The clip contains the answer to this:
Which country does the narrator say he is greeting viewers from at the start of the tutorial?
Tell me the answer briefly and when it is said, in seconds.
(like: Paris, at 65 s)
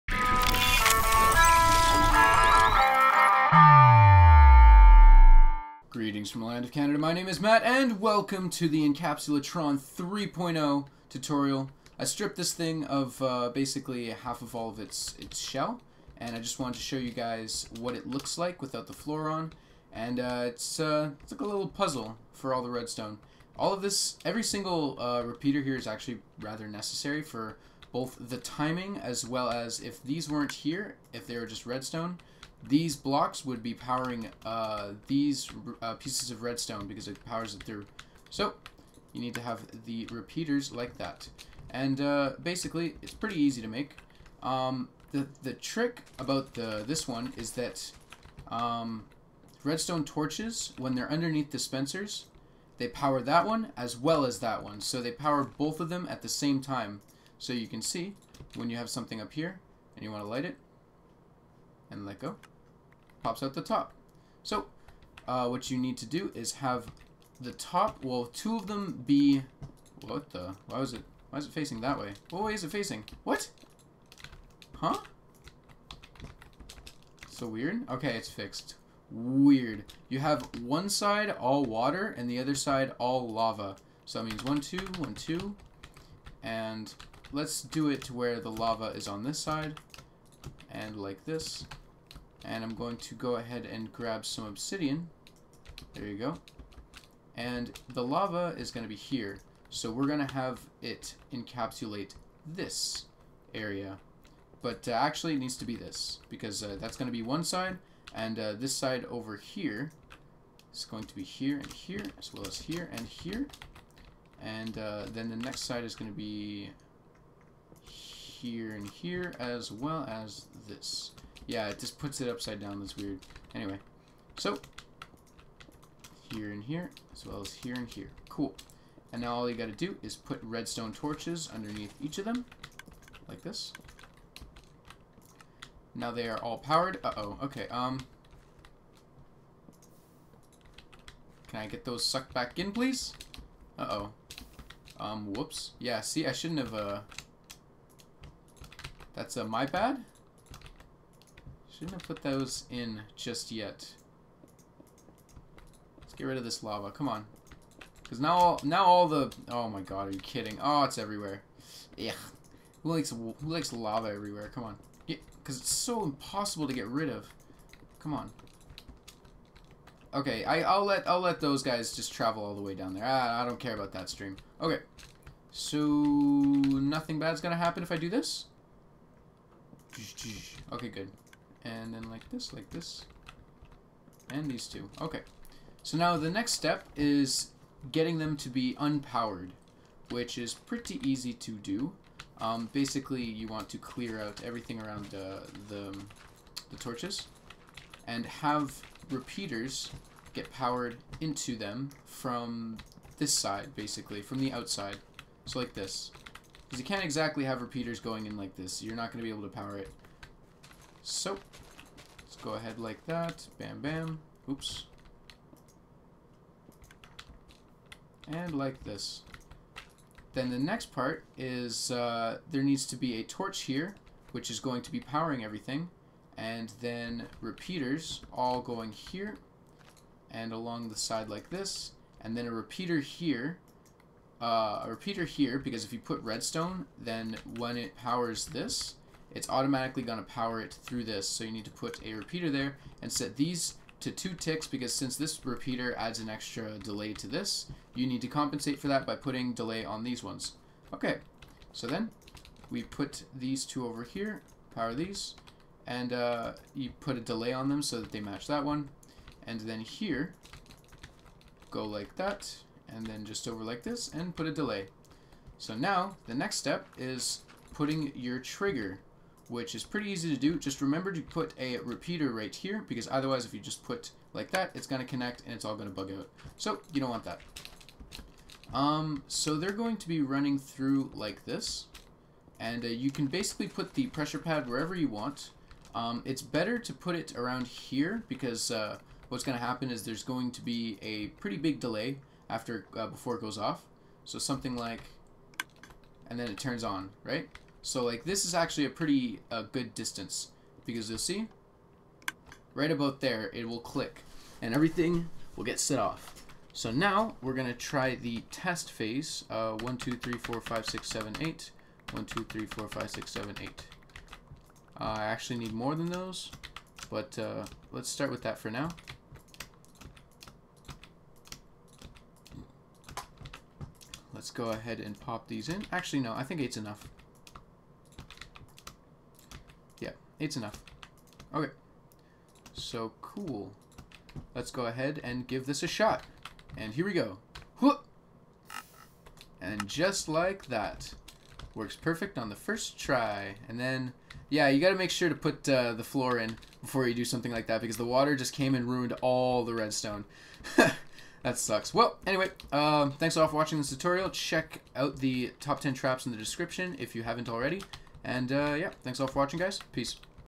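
Canada, at 6 s.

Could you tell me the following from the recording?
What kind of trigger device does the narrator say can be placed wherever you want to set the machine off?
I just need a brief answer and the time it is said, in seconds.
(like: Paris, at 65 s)
pressure pad, at 284 s.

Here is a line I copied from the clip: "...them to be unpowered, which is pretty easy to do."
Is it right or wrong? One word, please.
right.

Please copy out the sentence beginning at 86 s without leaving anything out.
And let's do it to where the lava is on this side and like this.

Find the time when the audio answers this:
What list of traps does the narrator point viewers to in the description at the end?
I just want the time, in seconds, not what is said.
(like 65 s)
355 s.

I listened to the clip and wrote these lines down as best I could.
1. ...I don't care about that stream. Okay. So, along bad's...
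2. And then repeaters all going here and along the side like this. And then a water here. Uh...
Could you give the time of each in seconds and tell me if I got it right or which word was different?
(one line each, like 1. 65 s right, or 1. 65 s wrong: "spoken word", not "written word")
1. 173 s wrong: "nothing", not "along"
2. 226 s wrong: "repeater", not "water".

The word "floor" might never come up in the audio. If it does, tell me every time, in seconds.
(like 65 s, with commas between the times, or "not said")
18 s, 346 s.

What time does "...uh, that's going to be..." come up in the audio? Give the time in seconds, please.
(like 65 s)
106 s.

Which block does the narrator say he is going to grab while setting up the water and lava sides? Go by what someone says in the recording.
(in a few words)
obsidian.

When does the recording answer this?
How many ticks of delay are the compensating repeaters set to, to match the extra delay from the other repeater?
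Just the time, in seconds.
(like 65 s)
244 s.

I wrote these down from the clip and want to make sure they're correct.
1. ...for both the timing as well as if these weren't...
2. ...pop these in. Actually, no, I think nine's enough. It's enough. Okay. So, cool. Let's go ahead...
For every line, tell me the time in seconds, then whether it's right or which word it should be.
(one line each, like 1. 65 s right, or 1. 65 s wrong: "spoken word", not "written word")
1. 27 s right
2. 325 s wrong: "eight", not "nine".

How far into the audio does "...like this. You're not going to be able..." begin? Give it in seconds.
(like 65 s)
208 s.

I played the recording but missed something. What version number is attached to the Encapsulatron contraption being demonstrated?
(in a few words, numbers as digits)
3.0.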